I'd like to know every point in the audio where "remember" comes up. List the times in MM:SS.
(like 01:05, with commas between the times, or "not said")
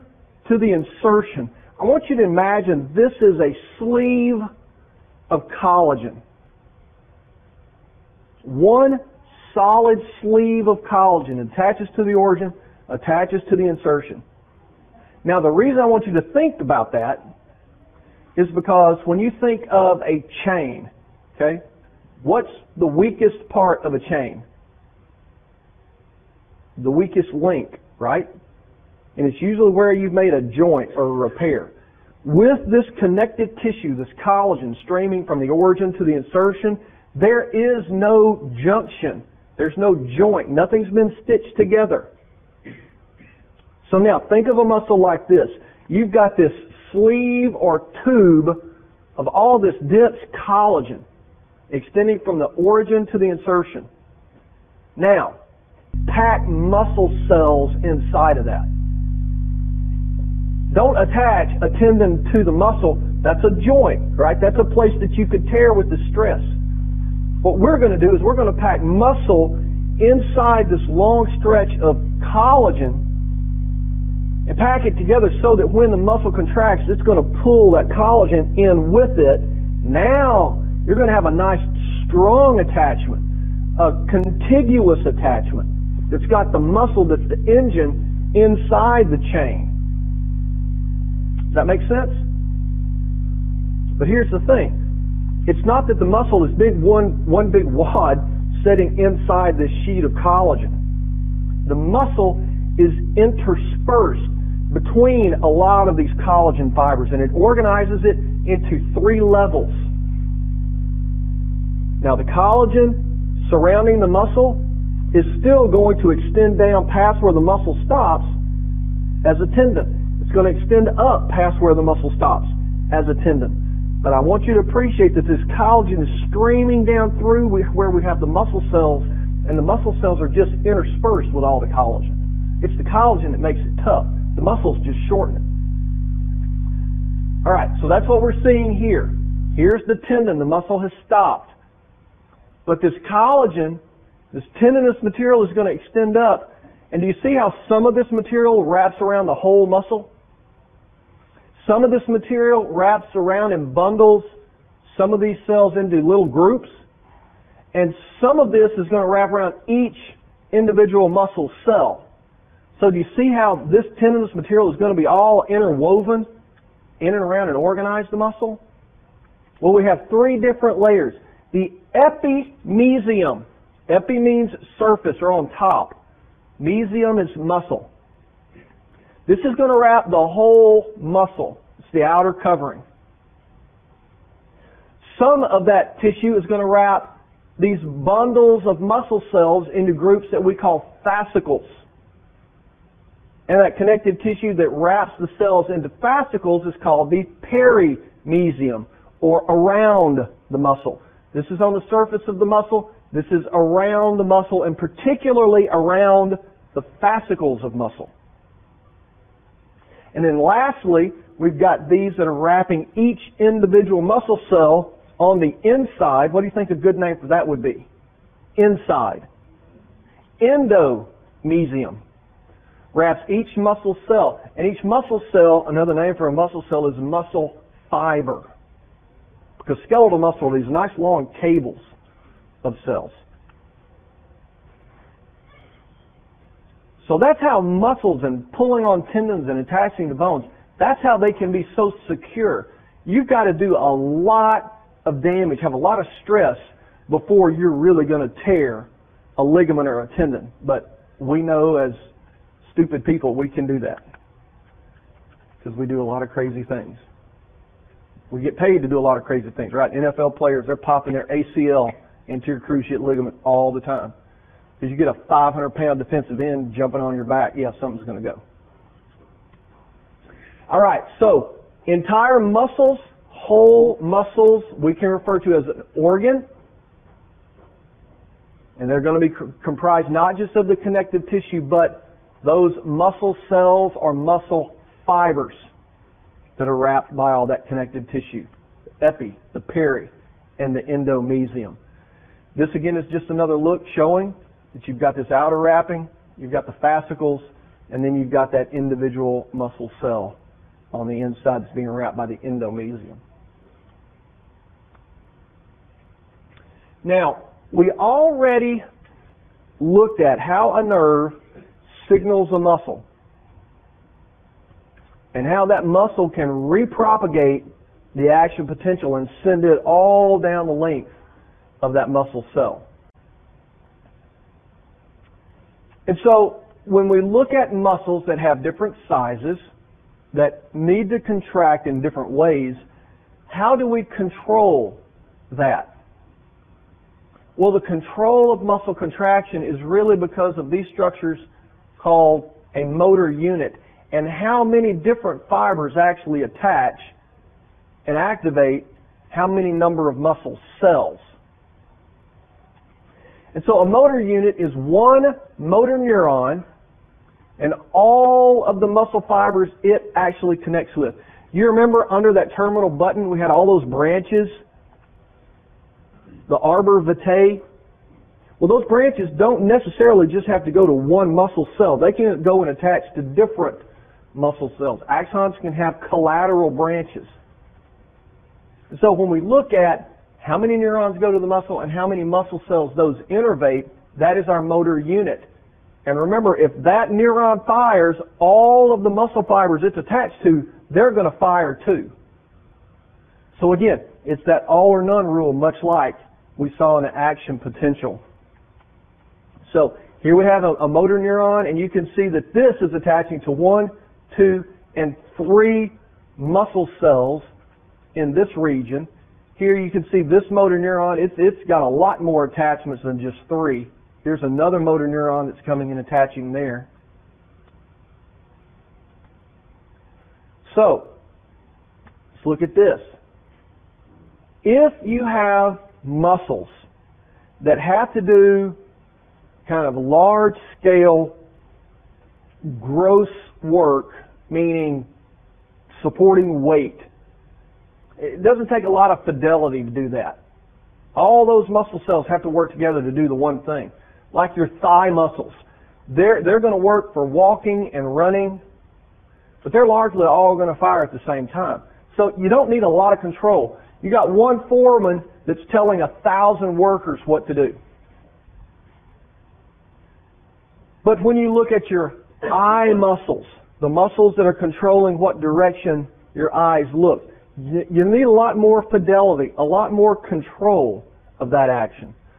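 06:01, 06:26.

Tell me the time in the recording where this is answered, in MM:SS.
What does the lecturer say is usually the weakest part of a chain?
00:26.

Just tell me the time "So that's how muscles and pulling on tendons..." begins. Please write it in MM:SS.
03:57.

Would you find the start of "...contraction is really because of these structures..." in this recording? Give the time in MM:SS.
05:38.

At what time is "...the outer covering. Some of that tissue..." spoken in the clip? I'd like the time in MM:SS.
03:01.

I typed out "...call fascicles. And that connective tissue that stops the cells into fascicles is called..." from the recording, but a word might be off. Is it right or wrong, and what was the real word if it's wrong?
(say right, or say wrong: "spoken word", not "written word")
wrong: "wraps", not "stops".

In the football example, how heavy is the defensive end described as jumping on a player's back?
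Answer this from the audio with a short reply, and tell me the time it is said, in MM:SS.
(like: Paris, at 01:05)
500 pounds, at 04:25.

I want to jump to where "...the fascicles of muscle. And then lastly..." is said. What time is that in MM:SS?
03:26.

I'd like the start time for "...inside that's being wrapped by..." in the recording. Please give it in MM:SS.
05:01.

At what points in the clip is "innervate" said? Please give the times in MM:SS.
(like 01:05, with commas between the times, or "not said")
06:23.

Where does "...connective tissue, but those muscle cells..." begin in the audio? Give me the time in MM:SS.
04:40.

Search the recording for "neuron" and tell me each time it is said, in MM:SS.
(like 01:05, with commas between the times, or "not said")
05:55, 06:20, 06:27, 06:41, 06:50, 06:55.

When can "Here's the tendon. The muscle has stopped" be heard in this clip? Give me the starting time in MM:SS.
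02:19.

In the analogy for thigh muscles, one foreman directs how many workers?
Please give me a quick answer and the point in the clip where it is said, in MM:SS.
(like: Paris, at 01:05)
1,000, at 07:36.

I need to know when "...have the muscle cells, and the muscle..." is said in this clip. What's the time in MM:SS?
02:08.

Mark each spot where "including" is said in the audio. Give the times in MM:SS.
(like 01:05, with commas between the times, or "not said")
not said.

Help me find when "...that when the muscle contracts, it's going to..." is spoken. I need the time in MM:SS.
01:15.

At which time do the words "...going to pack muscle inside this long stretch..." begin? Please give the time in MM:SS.
01:08.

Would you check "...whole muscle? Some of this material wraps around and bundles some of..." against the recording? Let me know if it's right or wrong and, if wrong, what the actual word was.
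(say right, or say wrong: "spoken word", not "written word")
right.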